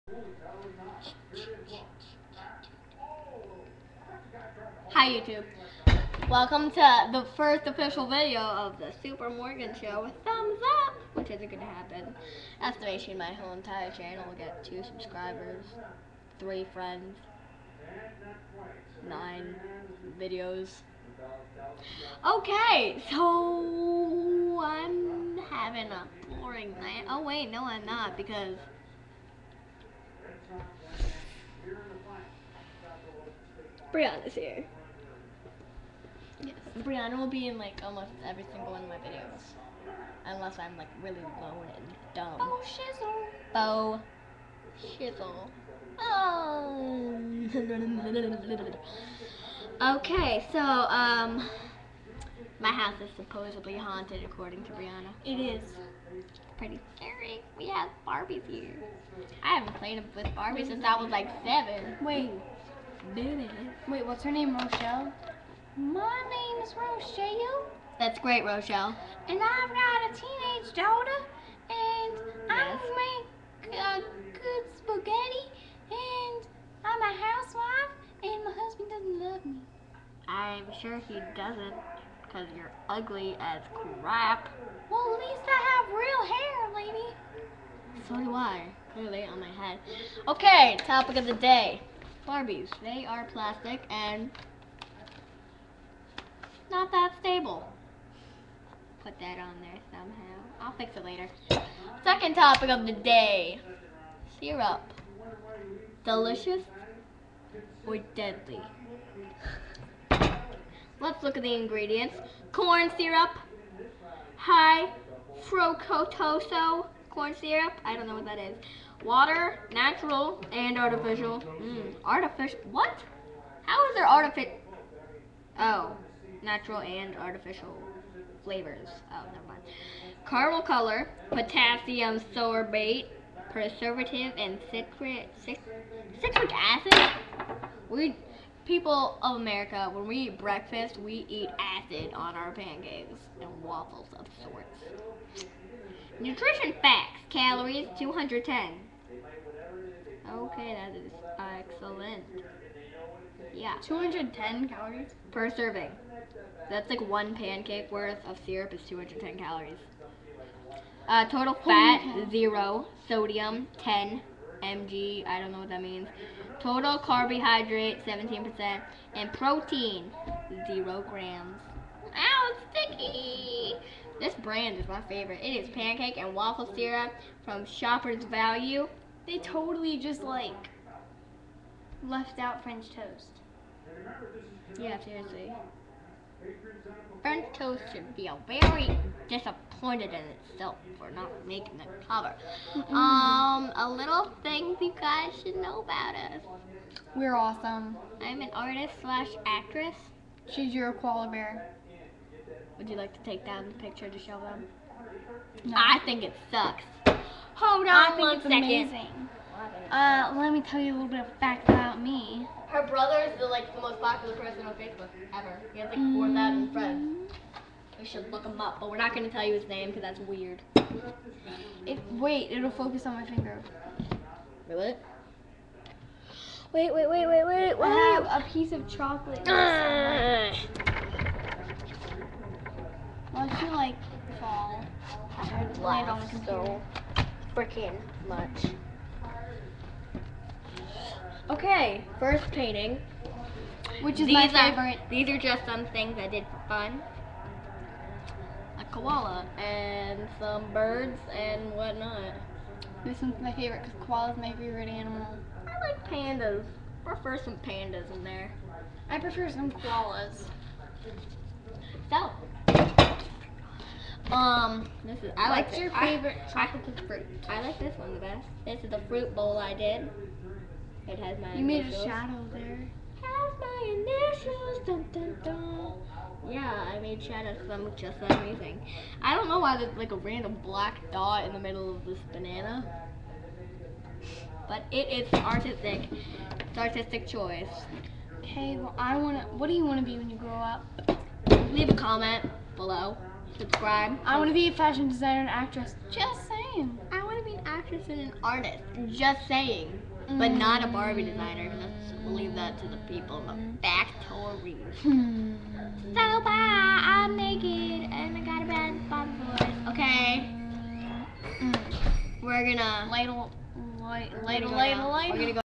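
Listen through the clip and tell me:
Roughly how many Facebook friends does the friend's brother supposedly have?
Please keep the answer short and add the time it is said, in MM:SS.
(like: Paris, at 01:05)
4,000, at 03:36.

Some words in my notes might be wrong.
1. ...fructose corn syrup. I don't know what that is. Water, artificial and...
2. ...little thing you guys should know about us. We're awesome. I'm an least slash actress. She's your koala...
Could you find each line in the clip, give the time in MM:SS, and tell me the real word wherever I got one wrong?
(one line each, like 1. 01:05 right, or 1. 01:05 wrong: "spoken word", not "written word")
1. 01:55 wrong: "natural", not "artificial"
2. 03:13 wrong: "artist", not "least".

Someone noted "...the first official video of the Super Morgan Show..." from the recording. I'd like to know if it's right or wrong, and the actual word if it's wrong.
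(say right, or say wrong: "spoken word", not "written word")
right.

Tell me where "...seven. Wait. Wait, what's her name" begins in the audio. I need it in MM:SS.
01:01.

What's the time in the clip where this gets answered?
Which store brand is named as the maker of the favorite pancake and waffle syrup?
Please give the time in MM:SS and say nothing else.
02:57.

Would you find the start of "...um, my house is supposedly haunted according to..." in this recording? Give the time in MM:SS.
00:50.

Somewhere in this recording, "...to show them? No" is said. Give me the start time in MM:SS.
03:24.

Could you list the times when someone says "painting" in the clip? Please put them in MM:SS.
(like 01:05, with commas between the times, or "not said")
04:02.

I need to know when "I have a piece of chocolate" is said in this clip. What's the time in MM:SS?
03:47.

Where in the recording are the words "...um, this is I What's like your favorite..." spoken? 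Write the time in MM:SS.
04:24.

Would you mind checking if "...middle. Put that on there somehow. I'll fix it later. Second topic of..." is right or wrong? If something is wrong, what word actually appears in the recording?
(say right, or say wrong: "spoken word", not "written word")
wrong: "stable", not "middle".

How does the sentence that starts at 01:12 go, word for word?
I make a good spaghetti, and I'm a housewife, and my husband doesn't love me.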